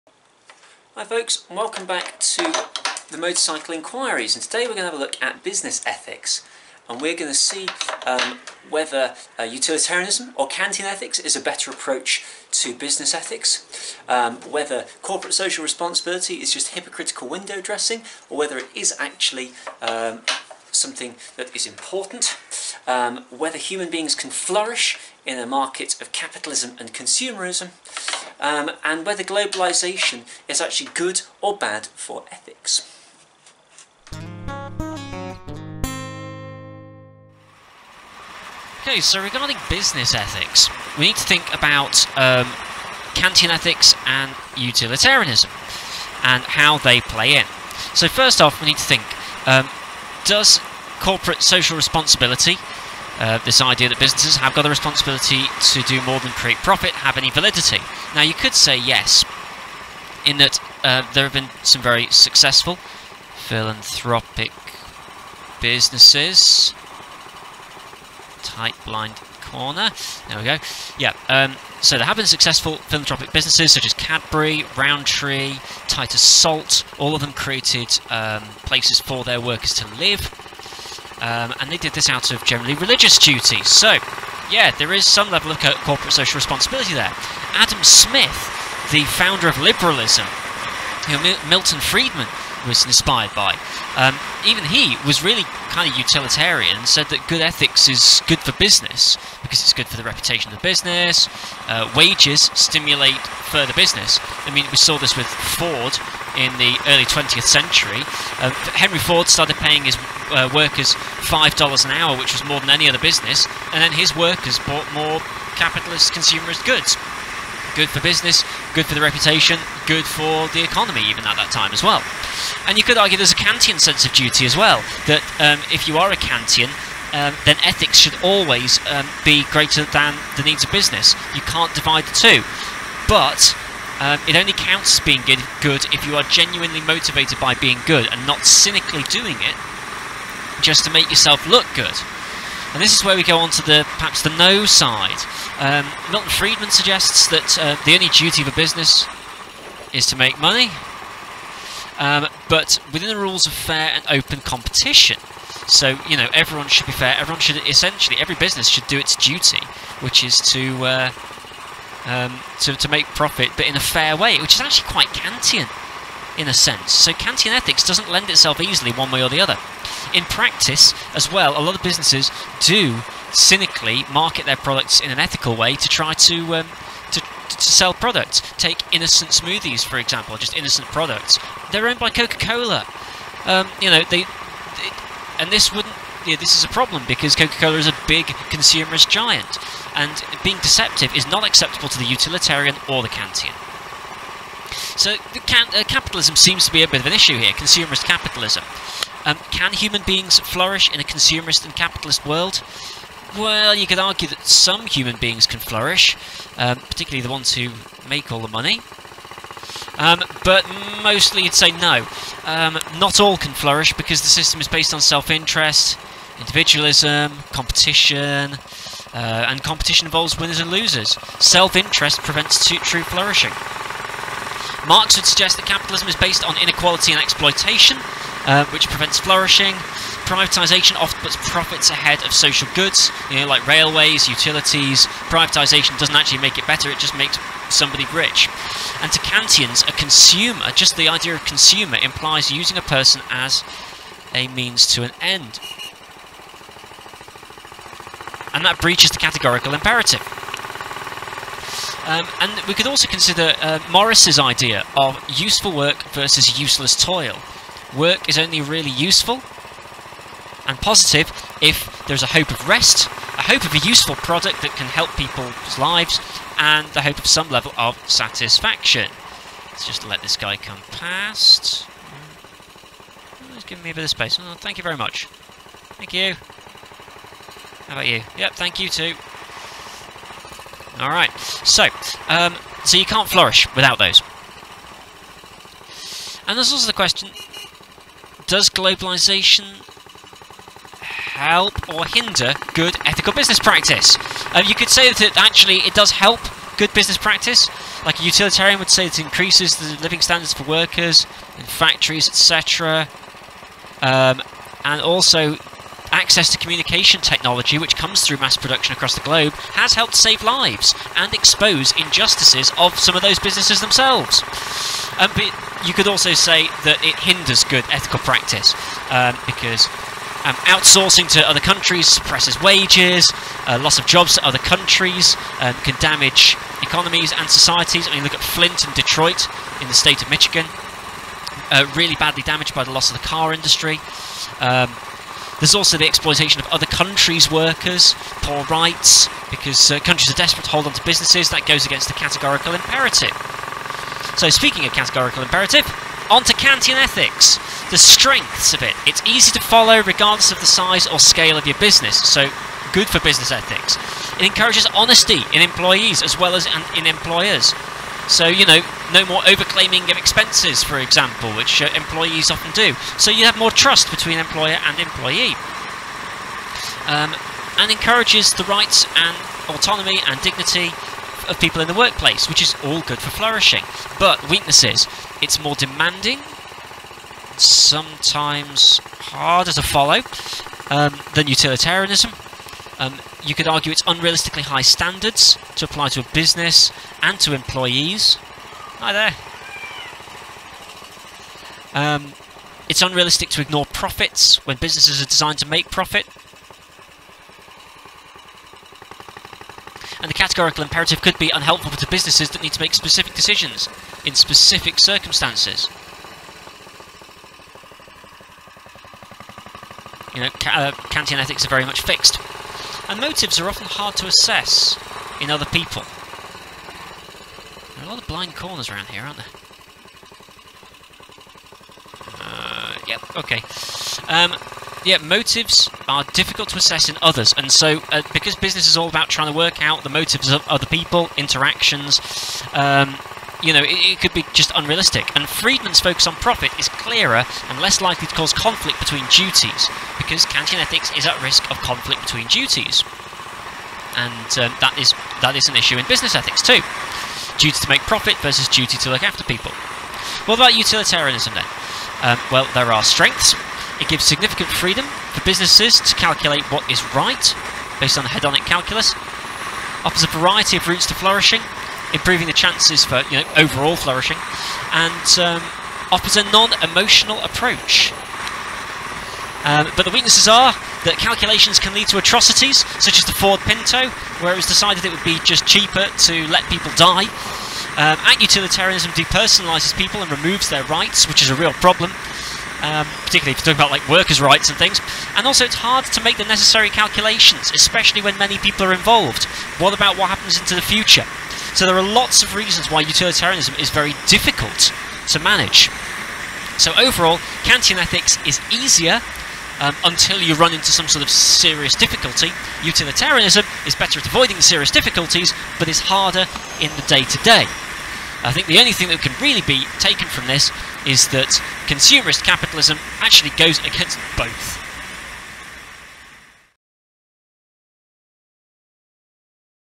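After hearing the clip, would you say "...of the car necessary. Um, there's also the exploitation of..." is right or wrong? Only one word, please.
wrong.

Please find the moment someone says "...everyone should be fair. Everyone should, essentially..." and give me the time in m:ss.
2:36.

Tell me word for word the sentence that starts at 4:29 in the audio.
Let's just let this guy come past.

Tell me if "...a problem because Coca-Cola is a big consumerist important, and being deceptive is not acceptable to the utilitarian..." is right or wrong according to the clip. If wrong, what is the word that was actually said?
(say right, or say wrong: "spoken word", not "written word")
wrong: "giant", not "important".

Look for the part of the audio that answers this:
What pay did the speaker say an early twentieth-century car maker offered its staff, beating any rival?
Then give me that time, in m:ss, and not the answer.
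1:51.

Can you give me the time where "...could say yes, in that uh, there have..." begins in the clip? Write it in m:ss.
0:58.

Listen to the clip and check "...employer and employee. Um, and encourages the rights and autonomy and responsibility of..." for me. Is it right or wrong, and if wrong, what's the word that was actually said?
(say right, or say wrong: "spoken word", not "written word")
wrong: "dignity", not "responsibility".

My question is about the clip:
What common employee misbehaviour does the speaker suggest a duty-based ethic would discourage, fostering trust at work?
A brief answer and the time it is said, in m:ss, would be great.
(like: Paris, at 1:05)
overclaiming of expenses, at 5:59.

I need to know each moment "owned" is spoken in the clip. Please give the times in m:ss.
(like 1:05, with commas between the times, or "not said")
3:01.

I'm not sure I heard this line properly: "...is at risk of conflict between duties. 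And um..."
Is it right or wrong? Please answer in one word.
right.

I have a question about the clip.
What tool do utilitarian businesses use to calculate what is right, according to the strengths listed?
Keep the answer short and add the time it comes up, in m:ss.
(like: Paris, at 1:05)
hedonic calculus, at 7:38.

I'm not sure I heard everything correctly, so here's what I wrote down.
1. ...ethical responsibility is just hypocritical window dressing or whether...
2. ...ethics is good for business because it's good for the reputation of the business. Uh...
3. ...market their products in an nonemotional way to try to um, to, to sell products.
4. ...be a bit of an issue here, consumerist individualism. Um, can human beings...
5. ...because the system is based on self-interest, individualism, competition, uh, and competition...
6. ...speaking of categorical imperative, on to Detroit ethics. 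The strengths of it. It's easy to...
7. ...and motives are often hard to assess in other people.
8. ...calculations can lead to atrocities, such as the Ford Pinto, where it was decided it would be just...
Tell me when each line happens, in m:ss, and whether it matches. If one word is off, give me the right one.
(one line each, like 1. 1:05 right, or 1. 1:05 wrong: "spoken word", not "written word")
1. 0:15 wrong: "social", not "ethical"
2. 1:37 right
3. 2:54 wrong: "ethical", not "nonemotional"
4. 3:16 wrong: "capitalism", not "individualism"
5. 3:33 right
6. 5:44 wrong: "Kantian", not "Detroit"
7. 6:53 right
8. 7:51 right.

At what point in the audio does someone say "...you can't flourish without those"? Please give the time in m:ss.
4:42.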